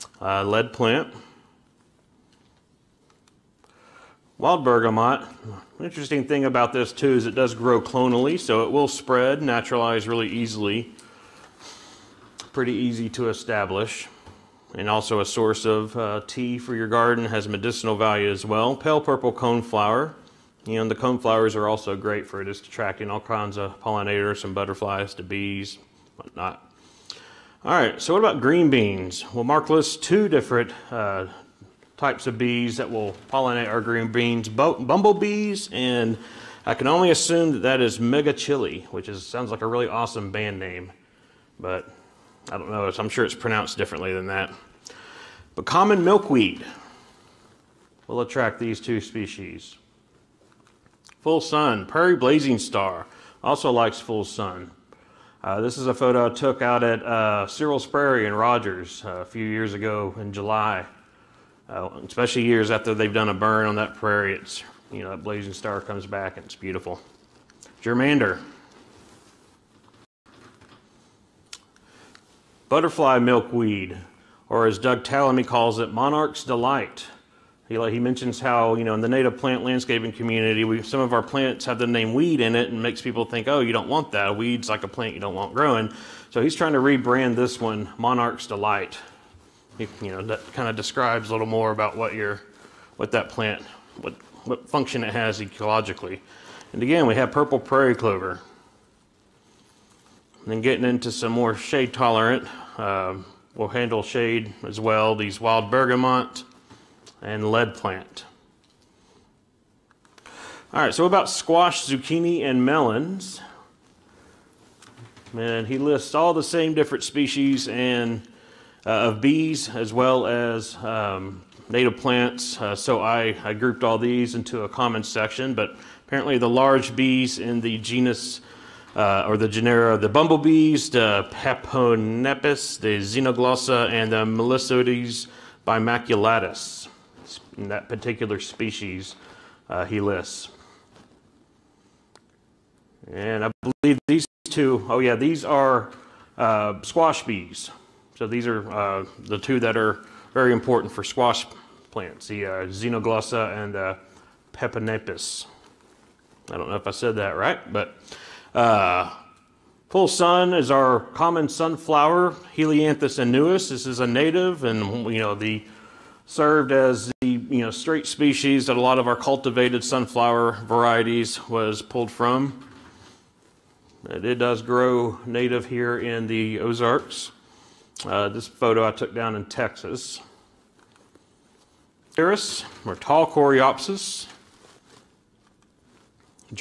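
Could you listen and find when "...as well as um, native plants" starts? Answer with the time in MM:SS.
01:59.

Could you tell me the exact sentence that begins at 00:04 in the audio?
Wild bergamot, interesting thing about this too is it does grow clonally, so it will spread, naturalize really easily.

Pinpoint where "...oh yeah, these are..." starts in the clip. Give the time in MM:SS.
02:24.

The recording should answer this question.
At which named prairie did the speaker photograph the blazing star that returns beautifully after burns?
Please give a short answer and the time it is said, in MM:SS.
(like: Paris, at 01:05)
Searles Prairie, at 00:57.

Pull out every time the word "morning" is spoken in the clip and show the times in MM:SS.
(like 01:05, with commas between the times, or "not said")
not said.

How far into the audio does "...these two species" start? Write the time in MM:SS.
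00:48.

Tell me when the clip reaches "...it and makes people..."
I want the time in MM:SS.
01:22.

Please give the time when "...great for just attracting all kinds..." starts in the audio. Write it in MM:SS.
00:21.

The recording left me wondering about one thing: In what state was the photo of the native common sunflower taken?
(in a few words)
Texas.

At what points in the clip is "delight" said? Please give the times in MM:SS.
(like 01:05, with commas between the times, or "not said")
01:16, 01:28.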